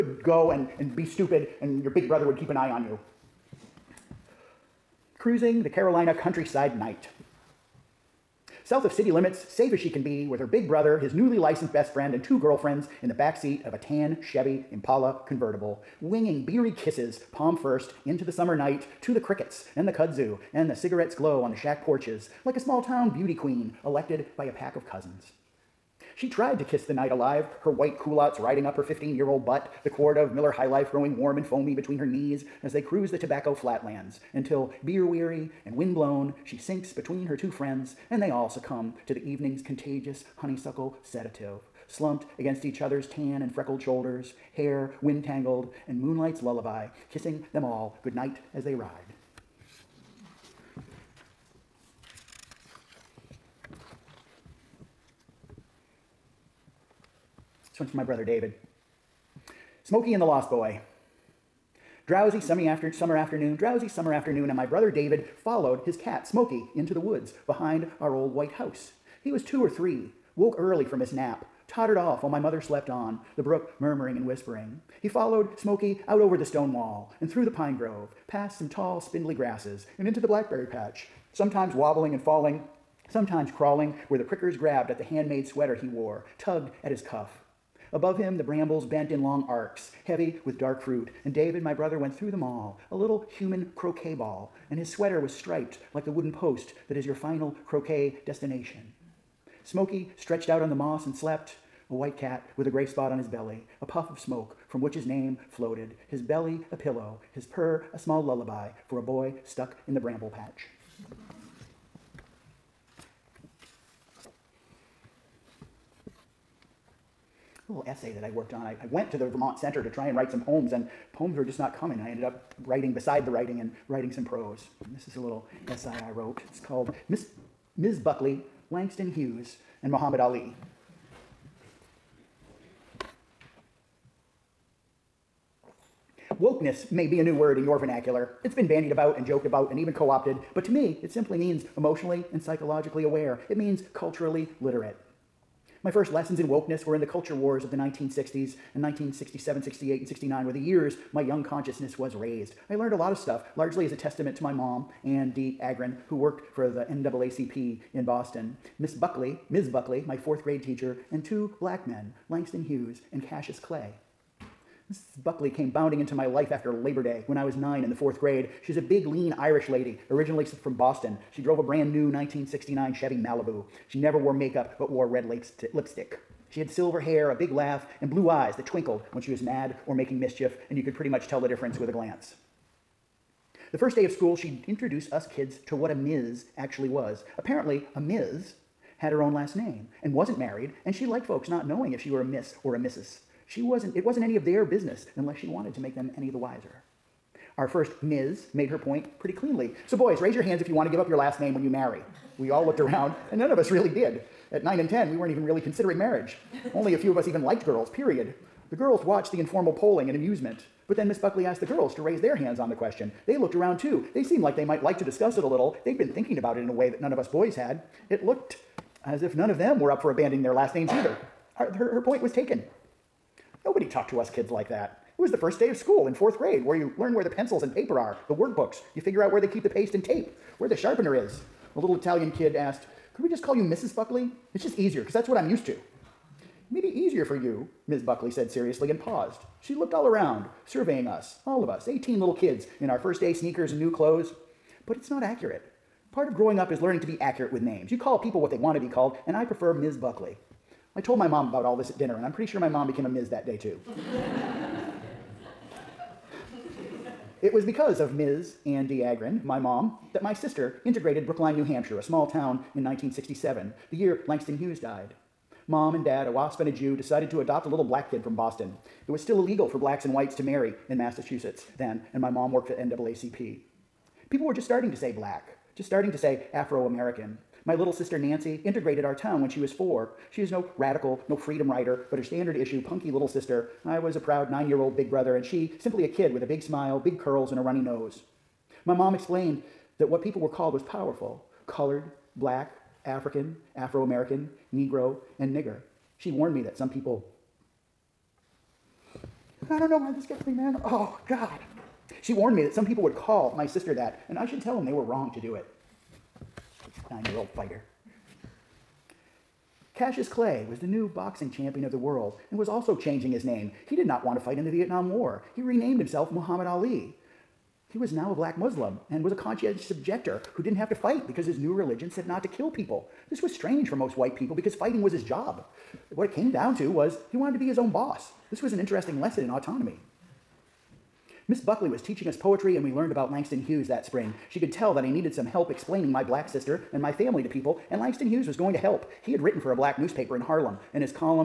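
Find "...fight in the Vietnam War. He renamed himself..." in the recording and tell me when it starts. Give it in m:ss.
5:14.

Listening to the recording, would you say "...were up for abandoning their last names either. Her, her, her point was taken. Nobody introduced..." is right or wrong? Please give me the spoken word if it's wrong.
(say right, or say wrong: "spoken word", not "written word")
wrong: "talked", not "introduced".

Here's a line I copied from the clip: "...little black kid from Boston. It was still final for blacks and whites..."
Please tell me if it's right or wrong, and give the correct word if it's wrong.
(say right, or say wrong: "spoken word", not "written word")
wrong: "illegal", not "final".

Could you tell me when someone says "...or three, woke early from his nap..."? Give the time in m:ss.
1:09.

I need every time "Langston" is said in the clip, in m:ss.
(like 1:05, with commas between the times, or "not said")
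2:08, 2:42, 4:24, 5:33, 5:37.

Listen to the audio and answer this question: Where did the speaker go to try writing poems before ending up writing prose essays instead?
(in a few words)
Vermont Center.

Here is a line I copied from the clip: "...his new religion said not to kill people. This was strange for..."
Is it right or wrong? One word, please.
right.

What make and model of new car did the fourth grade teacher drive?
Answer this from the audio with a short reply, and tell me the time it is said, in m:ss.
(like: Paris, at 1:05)
1969 Chevy Malibu, at 2:52.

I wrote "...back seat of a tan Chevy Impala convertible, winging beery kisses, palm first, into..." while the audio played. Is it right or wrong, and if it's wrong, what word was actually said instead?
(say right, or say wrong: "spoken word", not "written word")
right.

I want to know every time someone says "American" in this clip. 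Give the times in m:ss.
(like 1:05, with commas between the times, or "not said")
4:36, 4:54.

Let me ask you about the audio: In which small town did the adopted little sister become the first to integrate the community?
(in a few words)
Brookline, New Hampshire.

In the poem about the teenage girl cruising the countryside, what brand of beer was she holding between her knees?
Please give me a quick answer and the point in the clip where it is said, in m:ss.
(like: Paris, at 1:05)
Miller High Life, at 0:30.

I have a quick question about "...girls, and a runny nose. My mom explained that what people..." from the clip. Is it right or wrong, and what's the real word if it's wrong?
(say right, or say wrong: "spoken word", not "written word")
wrong: "curls", not "girls".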